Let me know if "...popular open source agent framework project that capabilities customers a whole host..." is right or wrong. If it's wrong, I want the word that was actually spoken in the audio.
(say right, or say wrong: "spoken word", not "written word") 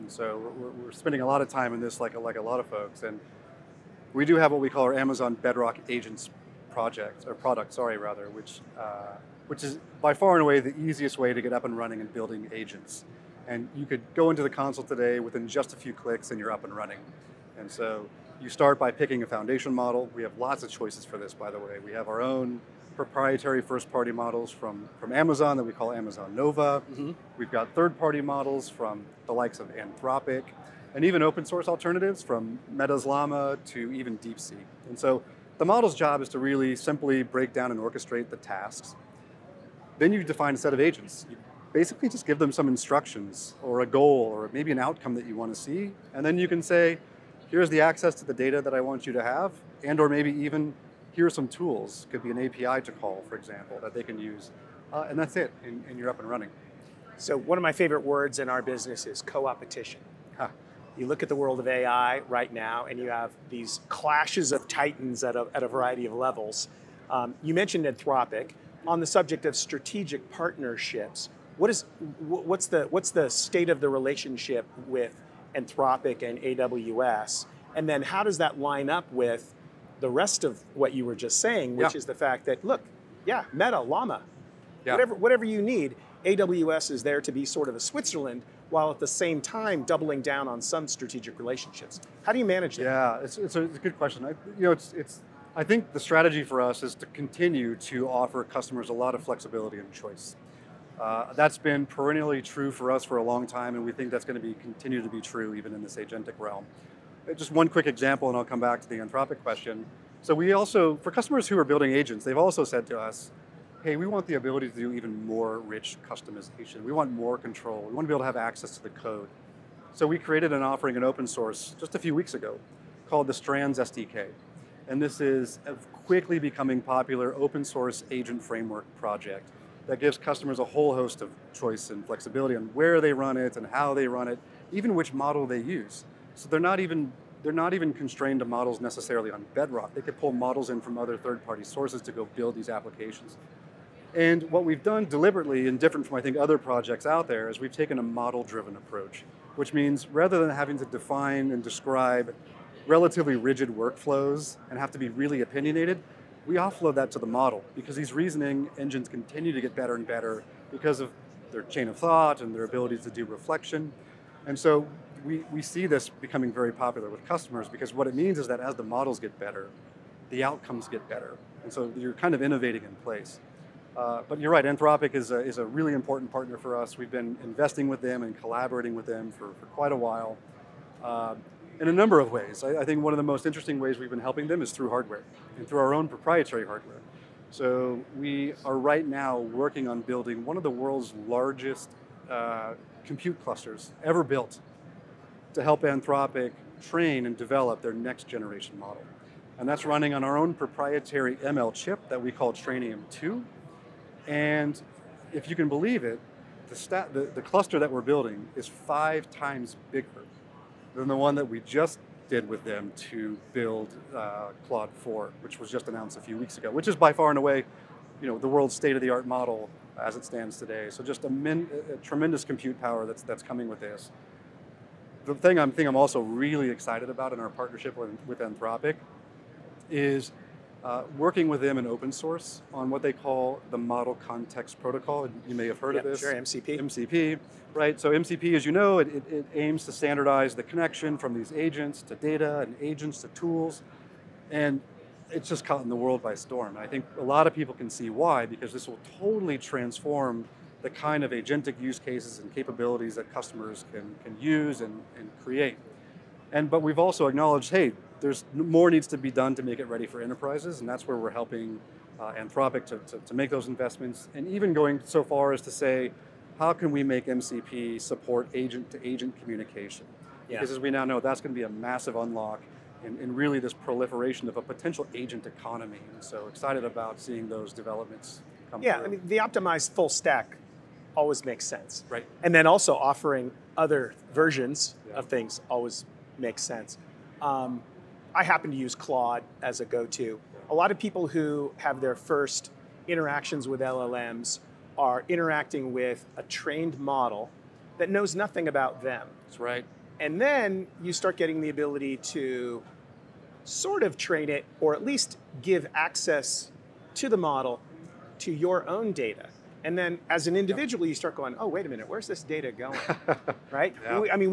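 wrong: "gives", not "capabilities".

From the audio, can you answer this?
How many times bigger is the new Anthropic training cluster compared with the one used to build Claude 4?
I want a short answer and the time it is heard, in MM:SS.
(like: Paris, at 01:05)
5 times, at 03:28.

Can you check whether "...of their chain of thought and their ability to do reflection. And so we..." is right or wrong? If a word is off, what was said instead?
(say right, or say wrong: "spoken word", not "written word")
right.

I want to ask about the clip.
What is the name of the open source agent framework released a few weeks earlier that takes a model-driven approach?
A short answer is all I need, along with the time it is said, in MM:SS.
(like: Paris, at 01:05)
Strands SDK, at 02:03.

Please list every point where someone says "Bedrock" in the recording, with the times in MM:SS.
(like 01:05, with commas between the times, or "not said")
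00:05, 02:19.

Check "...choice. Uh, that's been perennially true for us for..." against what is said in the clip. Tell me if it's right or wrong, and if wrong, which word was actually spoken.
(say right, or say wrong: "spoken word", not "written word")
right.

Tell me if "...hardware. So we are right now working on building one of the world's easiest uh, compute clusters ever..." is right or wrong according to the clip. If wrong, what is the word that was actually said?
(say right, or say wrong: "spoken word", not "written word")
wrong: "largest", not "easiest".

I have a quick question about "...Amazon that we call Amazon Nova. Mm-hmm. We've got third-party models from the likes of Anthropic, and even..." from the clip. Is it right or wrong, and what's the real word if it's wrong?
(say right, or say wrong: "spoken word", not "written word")
right.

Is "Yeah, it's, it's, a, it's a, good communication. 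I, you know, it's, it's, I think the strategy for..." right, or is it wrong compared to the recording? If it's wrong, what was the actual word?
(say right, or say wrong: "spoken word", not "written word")
wrong: "question", not "communication".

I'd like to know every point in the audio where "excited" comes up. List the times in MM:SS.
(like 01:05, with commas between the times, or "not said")
03:46, 04:36.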